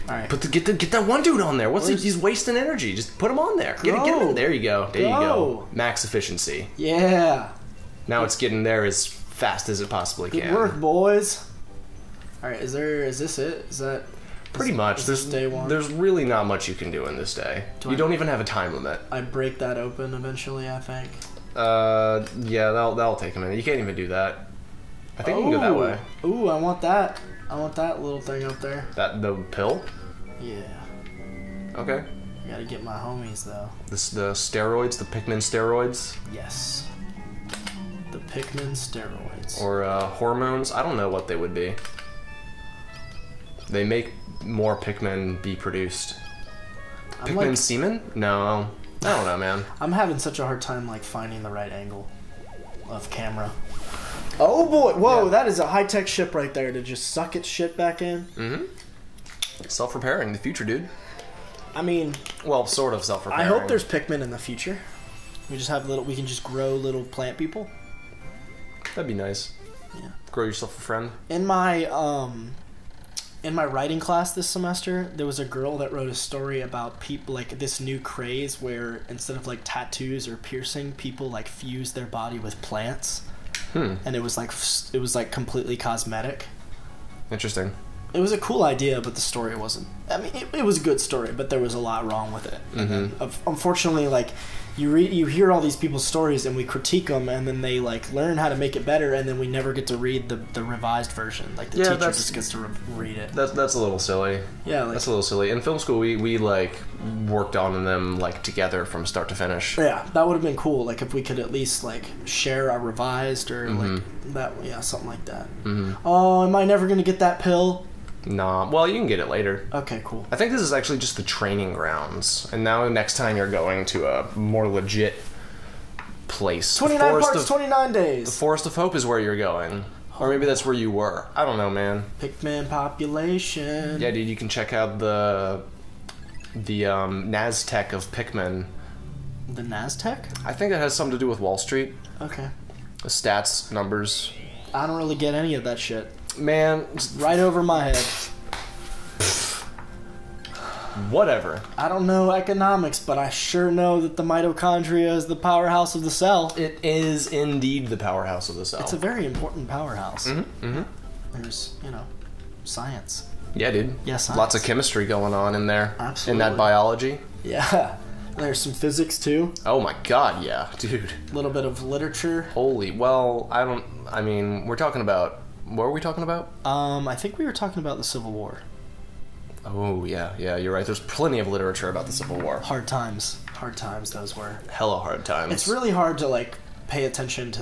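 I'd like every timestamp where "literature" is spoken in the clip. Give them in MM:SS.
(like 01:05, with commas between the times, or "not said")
02:51, 03:01.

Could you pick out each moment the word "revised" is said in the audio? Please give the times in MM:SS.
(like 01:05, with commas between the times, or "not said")
01:40, 01:52.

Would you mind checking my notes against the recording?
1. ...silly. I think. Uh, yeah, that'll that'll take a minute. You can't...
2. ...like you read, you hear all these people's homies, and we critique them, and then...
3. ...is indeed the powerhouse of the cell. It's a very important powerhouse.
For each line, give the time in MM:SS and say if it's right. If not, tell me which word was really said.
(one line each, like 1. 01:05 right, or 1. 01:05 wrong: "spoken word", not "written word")
1. 00:20 wrong: "eventually", not "silly"
2. 01:34 wrong: "stories", not "homies"
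3. 02:36 right.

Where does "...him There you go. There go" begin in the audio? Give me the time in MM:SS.
00:04.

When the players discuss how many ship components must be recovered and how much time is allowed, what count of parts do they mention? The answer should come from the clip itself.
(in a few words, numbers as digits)
29.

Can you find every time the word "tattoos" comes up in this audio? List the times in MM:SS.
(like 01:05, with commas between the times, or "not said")
01:19.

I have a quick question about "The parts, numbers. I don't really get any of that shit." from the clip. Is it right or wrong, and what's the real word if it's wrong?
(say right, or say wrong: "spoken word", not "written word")
wrong: "stats", not "parts".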